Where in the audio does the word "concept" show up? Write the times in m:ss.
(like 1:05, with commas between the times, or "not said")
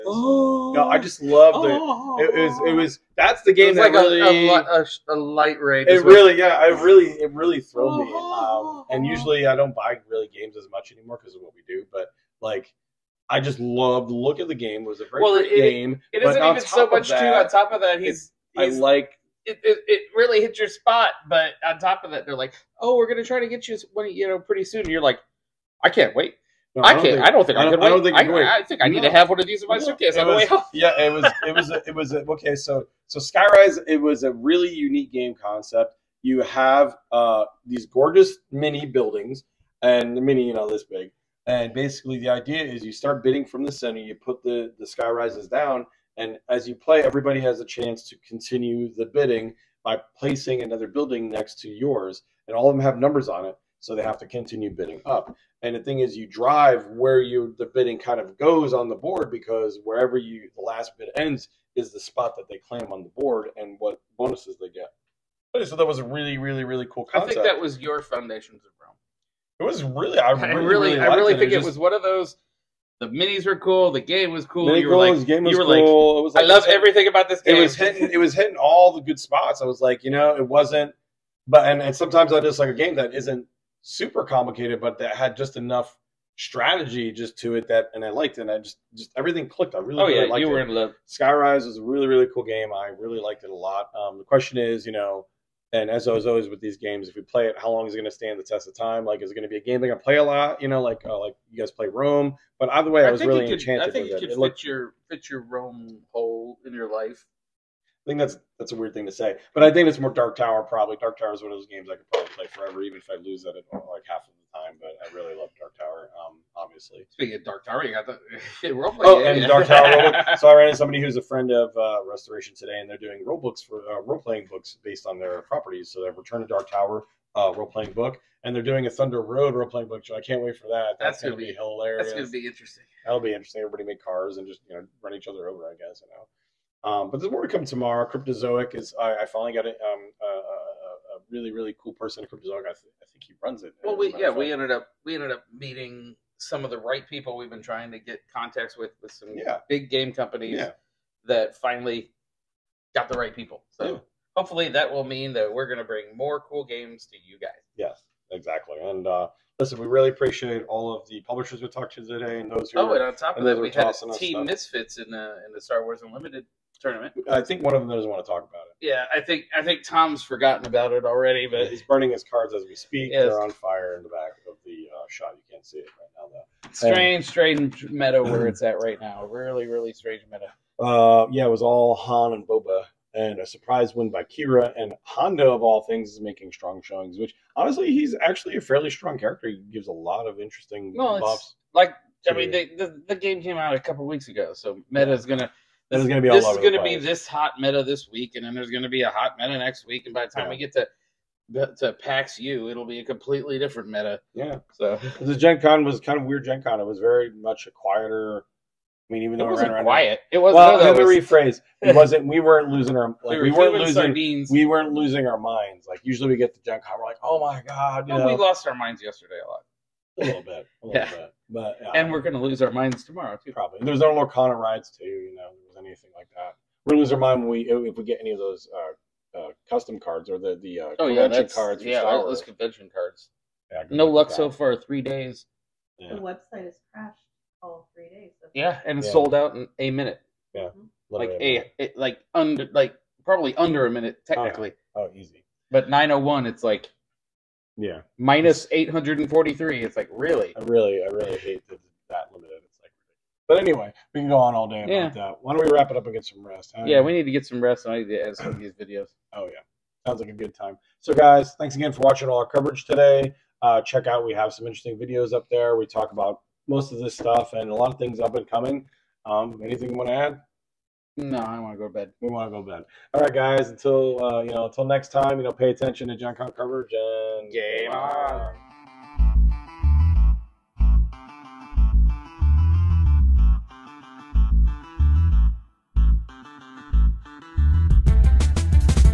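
0:35, 1:07.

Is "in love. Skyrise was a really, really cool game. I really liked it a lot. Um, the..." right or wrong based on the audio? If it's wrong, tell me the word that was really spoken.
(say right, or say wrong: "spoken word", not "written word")
right.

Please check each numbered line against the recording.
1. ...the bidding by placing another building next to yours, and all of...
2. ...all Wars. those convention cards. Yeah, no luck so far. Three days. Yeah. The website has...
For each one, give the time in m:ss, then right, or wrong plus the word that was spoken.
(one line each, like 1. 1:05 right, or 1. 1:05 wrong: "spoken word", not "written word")
1. 0:48 right
2. 3:52 right.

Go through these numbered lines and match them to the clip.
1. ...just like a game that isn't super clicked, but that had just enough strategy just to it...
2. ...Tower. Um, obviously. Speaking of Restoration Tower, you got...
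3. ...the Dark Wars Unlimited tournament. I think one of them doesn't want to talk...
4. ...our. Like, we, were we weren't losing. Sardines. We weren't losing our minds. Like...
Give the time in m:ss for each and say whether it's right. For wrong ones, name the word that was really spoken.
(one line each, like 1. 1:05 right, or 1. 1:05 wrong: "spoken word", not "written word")
1. 1:22 wrong: "complicated", not "clicked"
2. 1:55 wrong: "Dark", not "Restoration"
3. 2:45 wrong: "Star", not "Dark"
4. 3:32 right.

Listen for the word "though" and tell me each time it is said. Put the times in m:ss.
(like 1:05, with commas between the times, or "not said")
2:56, 3:29.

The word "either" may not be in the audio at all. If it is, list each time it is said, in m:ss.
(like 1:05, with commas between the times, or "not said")
1:42.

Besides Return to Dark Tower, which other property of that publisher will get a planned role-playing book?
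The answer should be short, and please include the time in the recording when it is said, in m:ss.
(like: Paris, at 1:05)
Thunder Road, at 2:08.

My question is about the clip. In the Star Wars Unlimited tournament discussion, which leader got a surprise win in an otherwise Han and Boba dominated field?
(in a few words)
Qi'ra.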